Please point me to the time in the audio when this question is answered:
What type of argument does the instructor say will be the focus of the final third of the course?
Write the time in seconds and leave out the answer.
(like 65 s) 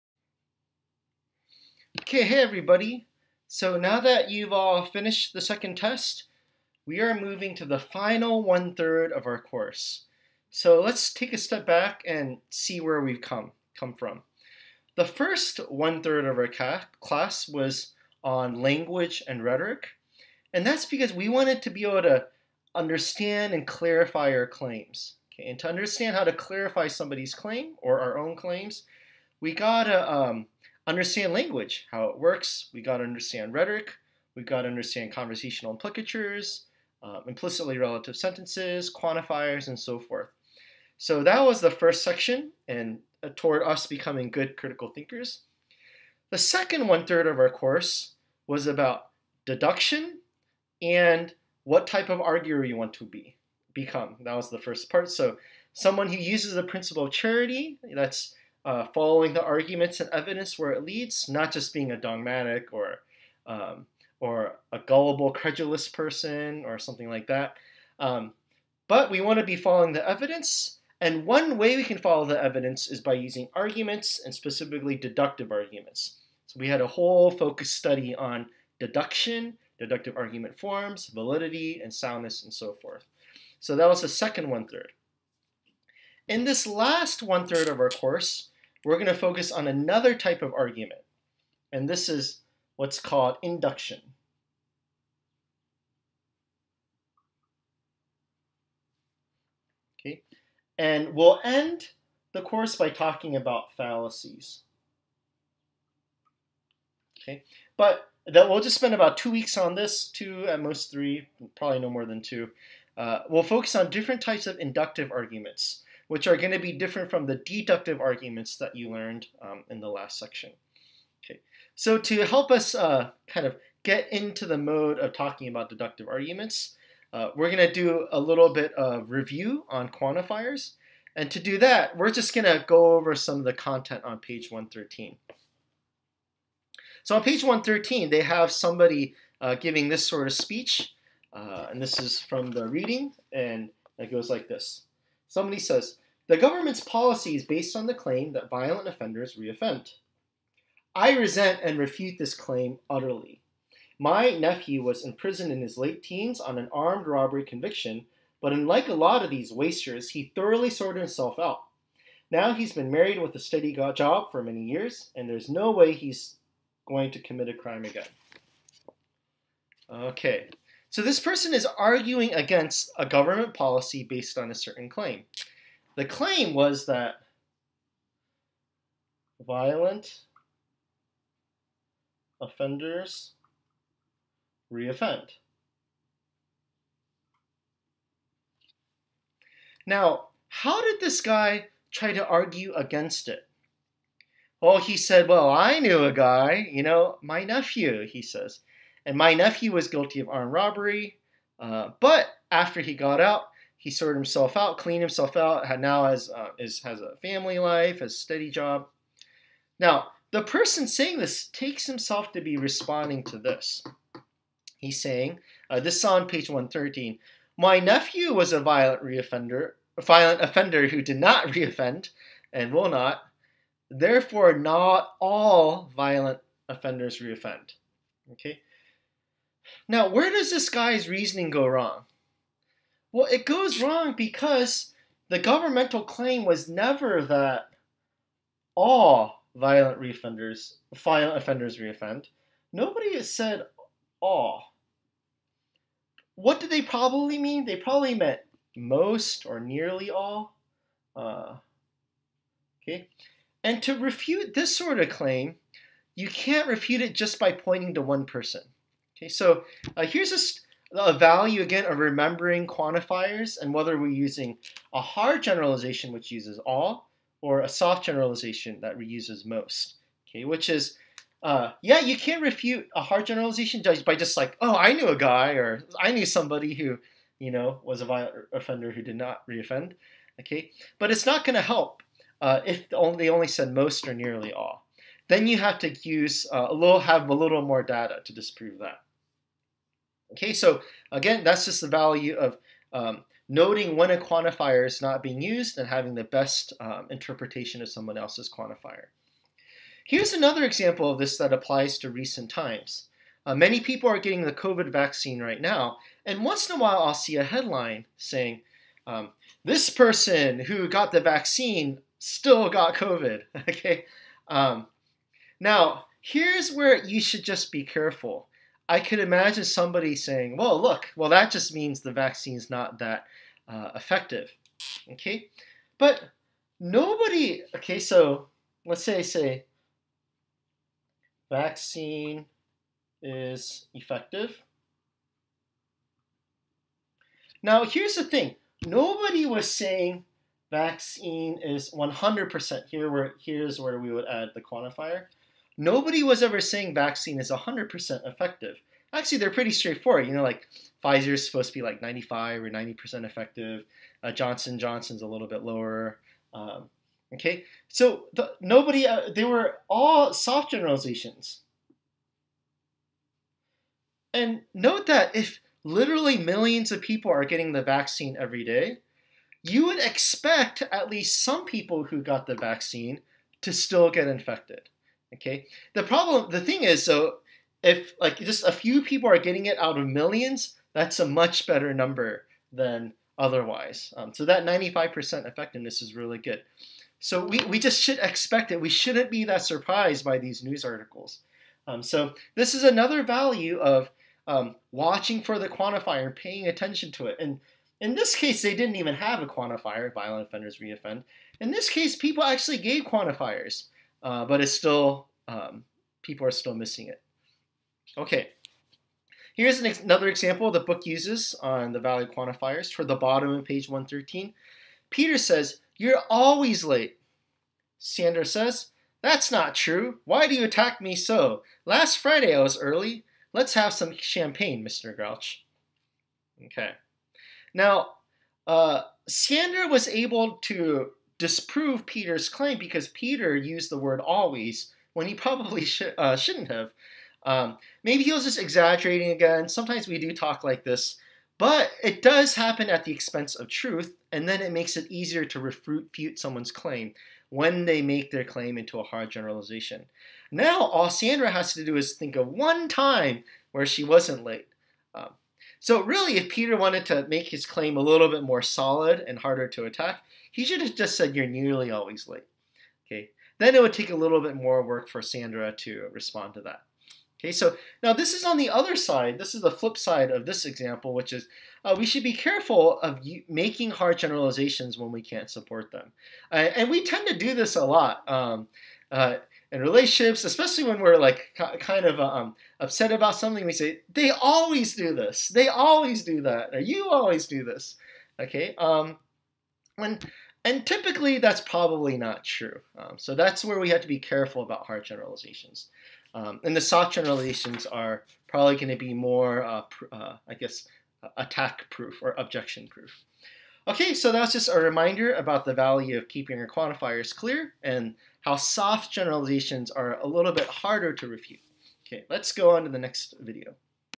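93 s.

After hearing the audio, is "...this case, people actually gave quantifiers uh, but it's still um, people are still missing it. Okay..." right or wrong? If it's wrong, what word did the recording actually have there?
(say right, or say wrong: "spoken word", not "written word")
right.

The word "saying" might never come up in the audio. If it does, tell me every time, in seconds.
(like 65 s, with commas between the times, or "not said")
210 s, 215 s, 308 s, 320 s, 339 s, 346 s.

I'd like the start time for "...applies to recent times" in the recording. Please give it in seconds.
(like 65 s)
301 s.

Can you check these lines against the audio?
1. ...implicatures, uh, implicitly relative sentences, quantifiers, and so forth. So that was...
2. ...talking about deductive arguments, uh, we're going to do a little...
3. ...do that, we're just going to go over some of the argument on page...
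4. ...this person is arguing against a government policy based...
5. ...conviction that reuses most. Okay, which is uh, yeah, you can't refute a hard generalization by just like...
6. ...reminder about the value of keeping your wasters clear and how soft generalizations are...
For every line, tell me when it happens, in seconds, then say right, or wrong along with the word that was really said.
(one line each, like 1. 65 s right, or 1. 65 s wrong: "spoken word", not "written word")
1. 35 s right
2. 125 s right
3. 131 s wrong: "content", not "argument"
4. 171 s right
5. 268 s wrong: "generalization", not "conviction"
6. 504 s wrong: "quantifiers", not "wasters".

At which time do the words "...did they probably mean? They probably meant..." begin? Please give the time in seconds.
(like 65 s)
246 s.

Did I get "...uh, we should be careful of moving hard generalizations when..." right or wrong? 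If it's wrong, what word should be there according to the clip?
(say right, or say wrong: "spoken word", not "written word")
wrong: "making", not "moving".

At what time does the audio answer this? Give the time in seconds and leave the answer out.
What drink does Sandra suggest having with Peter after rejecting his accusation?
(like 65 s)
424 s.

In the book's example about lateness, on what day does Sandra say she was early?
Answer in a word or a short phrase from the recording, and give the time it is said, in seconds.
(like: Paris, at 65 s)
Last Friday, at 421 s.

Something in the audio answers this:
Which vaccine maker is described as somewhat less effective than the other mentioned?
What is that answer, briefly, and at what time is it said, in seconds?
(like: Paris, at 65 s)
Johnson & Johnson, at 354 s.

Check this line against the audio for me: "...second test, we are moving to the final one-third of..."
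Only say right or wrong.
right.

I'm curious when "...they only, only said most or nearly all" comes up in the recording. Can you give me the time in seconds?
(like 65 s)
282 s.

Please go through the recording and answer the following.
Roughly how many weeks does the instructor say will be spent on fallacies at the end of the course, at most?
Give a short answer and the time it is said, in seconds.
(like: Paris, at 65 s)
3, at 110 s.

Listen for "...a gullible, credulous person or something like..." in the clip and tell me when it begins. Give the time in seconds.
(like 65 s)
64 s.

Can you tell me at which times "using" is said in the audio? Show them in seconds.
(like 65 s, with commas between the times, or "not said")
73 s, 264 s.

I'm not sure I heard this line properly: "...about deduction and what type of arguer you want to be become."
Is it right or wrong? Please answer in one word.
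right.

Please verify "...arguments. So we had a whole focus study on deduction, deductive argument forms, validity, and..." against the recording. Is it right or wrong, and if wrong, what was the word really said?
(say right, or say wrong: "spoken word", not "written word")
right.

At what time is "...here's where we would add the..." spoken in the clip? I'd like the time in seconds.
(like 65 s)
343 s.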